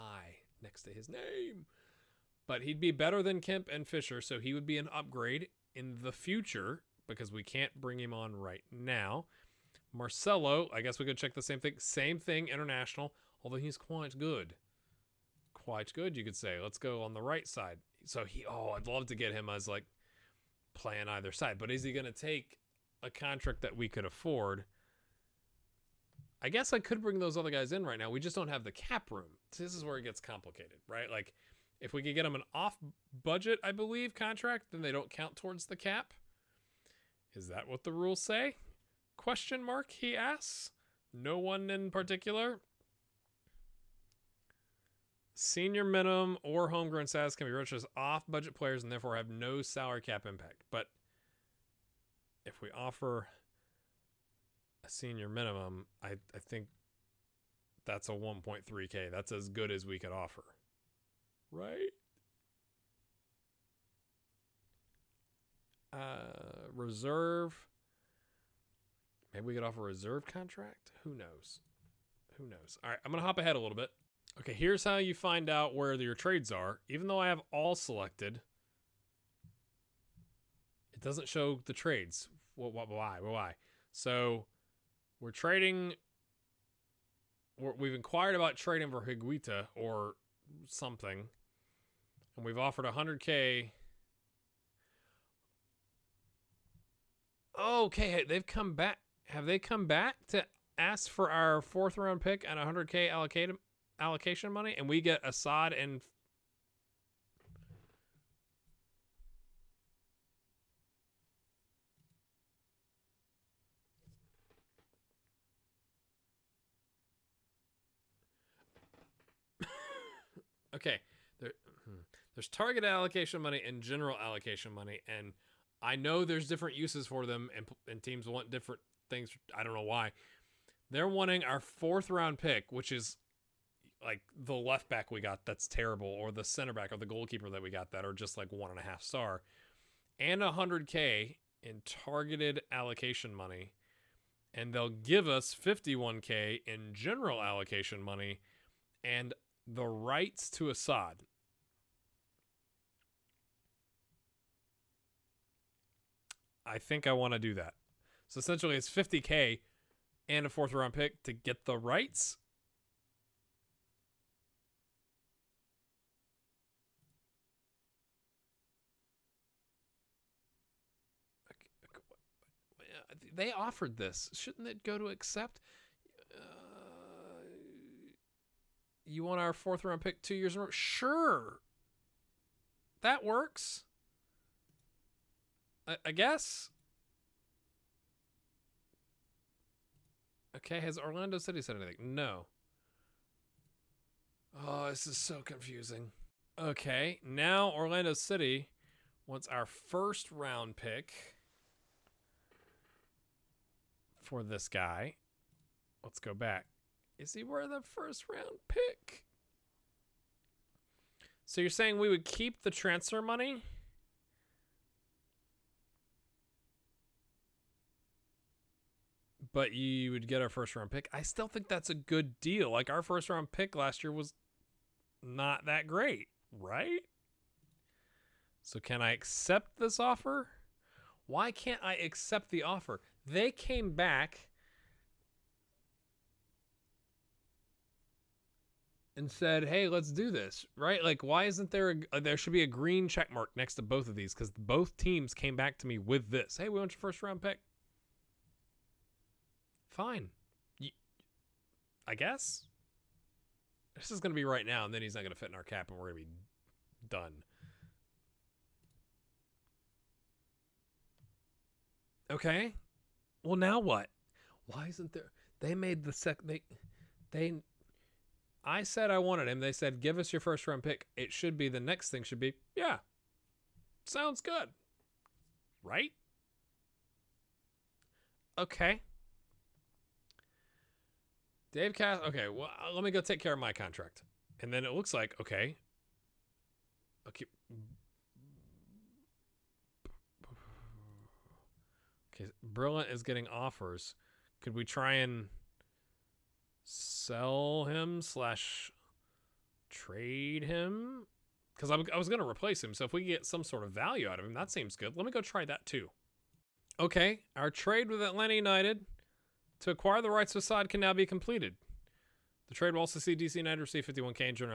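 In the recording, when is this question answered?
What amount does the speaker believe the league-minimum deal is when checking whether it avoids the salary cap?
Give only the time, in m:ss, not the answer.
0:58.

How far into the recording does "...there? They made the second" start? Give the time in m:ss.
4:25.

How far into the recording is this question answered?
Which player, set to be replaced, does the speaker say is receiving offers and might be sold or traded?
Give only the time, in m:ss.
4:52.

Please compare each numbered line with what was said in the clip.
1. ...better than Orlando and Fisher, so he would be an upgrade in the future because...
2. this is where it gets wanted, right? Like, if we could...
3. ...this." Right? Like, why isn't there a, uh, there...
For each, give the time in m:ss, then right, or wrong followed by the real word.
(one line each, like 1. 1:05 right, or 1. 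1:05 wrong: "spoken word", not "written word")
1. 0:02 wrong: "Kemp", not "Orlando"
2. 0:29 wrong: "complicated", not "wanted"
3. 4:00 right.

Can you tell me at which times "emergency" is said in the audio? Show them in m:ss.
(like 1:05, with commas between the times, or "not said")
not said.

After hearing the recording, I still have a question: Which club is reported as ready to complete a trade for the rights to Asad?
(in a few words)
Atlanta United.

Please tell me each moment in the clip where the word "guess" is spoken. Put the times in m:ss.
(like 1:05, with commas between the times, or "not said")
0:10, 0:26, 3:06, 4:12.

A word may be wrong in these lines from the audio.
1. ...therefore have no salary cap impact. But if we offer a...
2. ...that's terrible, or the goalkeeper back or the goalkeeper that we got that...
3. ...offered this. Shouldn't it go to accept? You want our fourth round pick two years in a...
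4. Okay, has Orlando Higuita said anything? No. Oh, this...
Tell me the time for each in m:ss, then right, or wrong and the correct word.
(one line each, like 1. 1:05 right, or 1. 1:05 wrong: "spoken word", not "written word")
1. 0:48 right
2. 2:15 wrong: "center", not "goalkeeper"
3. 2:53 right
4. 3:10 wrong: "City", not "Higuita".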